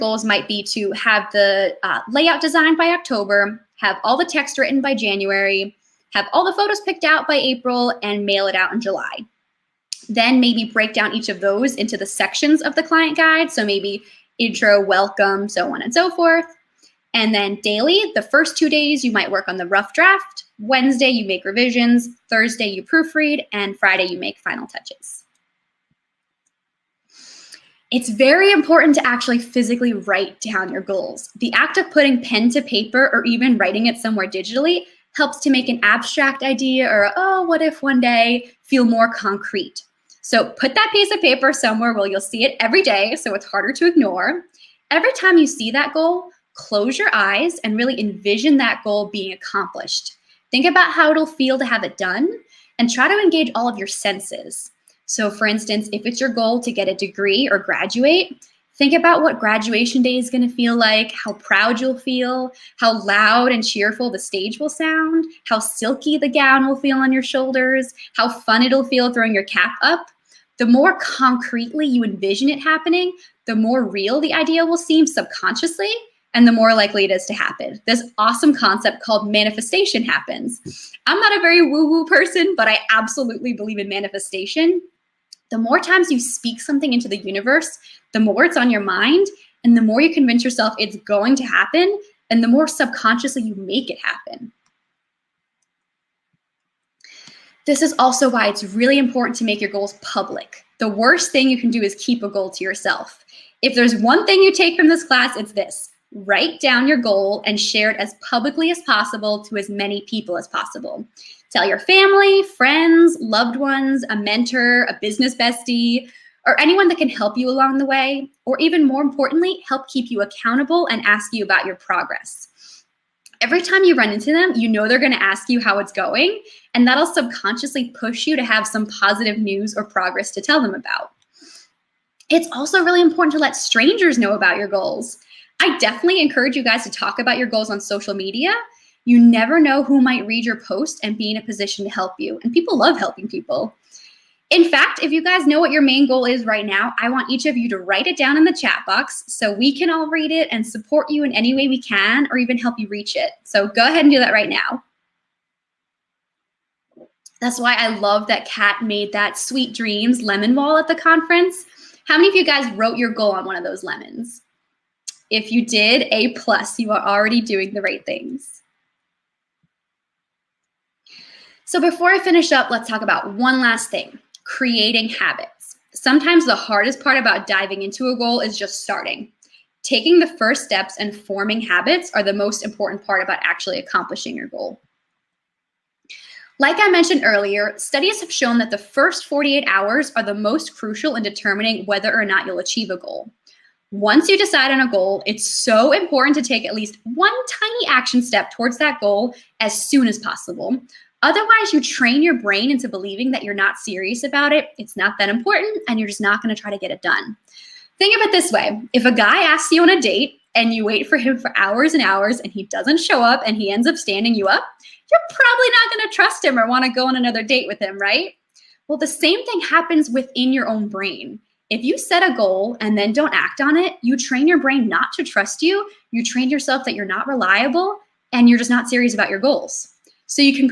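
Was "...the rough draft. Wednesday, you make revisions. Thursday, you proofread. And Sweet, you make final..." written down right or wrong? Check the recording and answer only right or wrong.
wrong.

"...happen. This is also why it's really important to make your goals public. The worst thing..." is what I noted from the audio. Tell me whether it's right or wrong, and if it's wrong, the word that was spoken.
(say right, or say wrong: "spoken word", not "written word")
right.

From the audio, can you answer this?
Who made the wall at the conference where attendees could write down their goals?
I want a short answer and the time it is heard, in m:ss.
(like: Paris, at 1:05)
Kat, at 2:38.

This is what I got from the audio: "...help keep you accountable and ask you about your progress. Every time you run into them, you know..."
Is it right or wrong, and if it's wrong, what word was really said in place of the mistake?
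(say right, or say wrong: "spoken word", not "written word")
right.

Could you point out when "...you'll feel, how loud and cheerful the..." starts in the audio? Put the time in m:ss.
1:01.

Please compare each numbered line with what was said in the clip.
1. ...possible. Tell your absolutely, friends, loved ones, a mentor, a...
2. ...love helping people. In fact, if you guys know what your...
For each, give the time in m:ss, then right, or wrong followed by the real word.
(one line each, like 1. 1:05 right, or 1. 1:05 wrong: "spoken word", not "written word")
1. 1:50 wrong: "family", not "absolutely"
2. 2:22 right.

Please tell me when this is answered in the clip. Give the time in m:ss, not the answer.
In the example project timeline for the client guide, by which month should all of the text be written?
0:04.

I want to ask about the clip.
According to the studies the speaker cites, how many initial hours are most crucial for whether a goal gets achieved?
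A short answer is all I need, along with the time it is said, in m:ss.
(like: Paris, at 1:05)
48, at 3:09.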